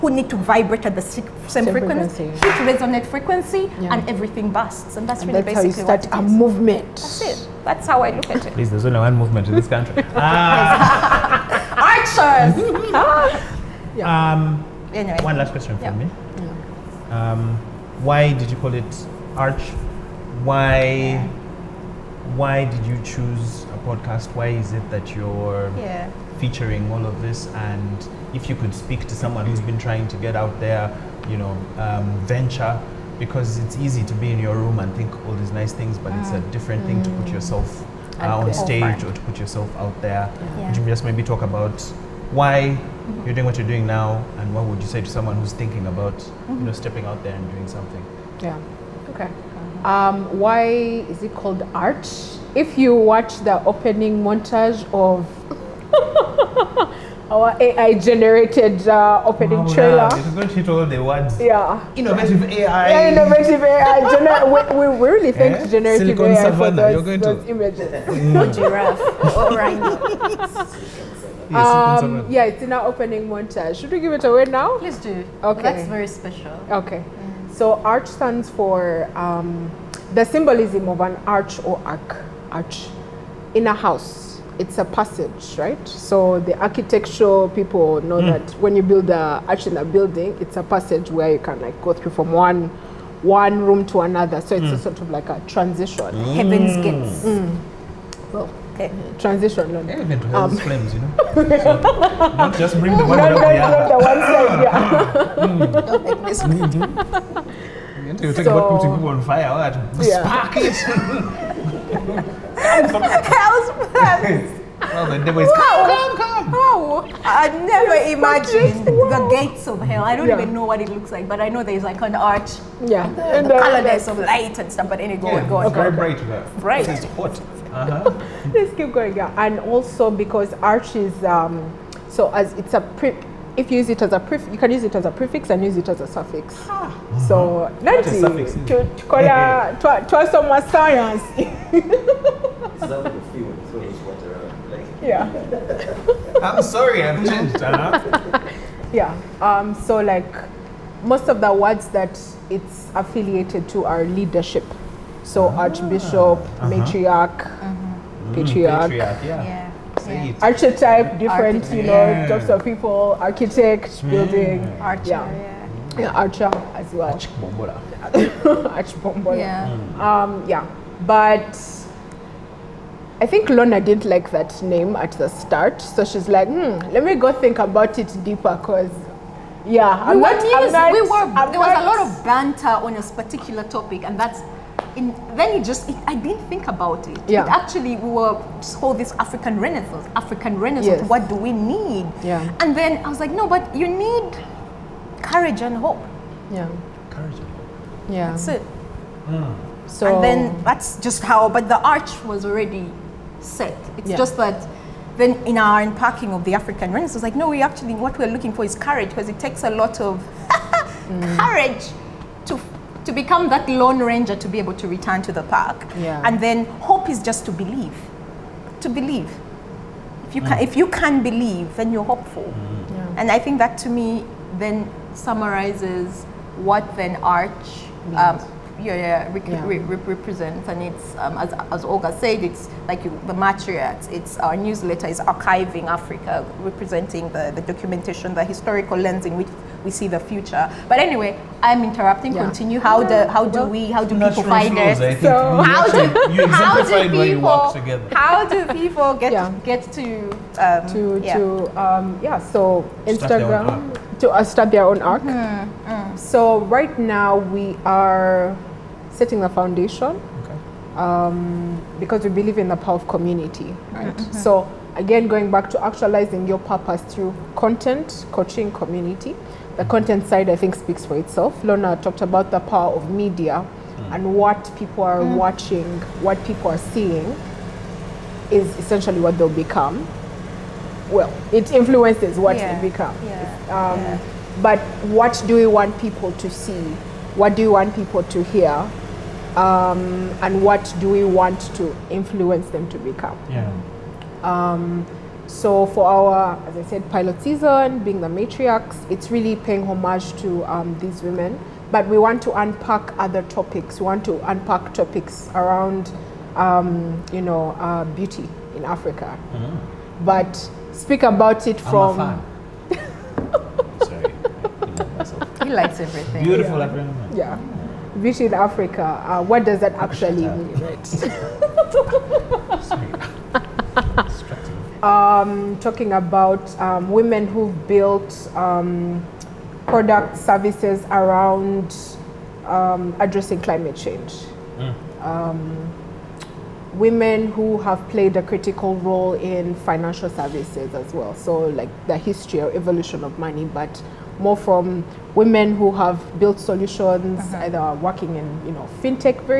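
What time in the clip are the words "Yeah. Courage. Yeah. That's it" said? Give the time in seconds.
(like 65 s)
196 s.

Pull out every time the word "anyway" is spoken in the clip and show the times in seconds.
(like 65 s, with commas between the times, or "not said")
14 s, 125 s, 240 s.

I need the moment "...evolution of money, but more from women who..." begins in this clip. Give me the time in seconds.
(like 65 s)
342 s.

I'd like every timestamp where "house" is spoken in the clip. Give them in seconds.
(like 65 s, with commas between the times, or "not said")
83 s, 112 s.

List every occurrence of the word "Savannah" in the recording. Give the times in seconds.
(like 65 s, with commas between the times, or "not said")
66 s.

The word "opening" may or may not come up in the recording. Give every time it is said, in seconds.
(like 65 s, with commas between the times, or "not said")
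53 s, 59 s, 72 s.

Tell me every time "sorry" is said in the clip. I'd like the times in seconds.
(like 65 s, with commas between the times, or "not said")
146 s, 315 s.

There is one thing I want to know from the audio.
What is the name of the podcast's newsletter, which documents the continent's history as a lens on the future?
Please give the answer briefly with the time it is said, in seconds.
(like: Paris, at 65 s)
Archiving Africa, at 235 s.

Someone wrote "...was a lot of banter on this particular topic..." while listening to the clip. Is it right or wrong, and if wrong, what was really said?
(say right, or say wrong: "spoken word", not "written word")
right.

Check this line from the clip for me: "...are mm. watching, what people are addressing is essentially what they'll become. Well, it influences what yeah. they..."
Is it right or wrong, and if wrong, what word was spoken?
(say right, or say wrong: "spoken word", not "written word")
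wrong: "seeing", not "addressing".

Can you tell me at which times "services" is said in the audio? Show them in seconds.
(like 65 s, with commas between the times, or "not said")
330 s, 340 s.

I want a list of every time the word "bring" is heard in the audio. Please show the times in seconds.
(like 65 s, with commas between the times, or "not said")
102 s.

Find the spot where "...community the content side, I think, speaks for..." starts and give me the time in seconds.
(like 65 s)
268 s.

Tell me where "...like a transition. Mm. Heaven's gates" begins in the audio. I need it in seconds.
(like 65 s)
95 s.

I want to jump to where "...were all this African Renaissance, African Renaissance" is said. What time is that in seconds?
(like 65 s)
188 s.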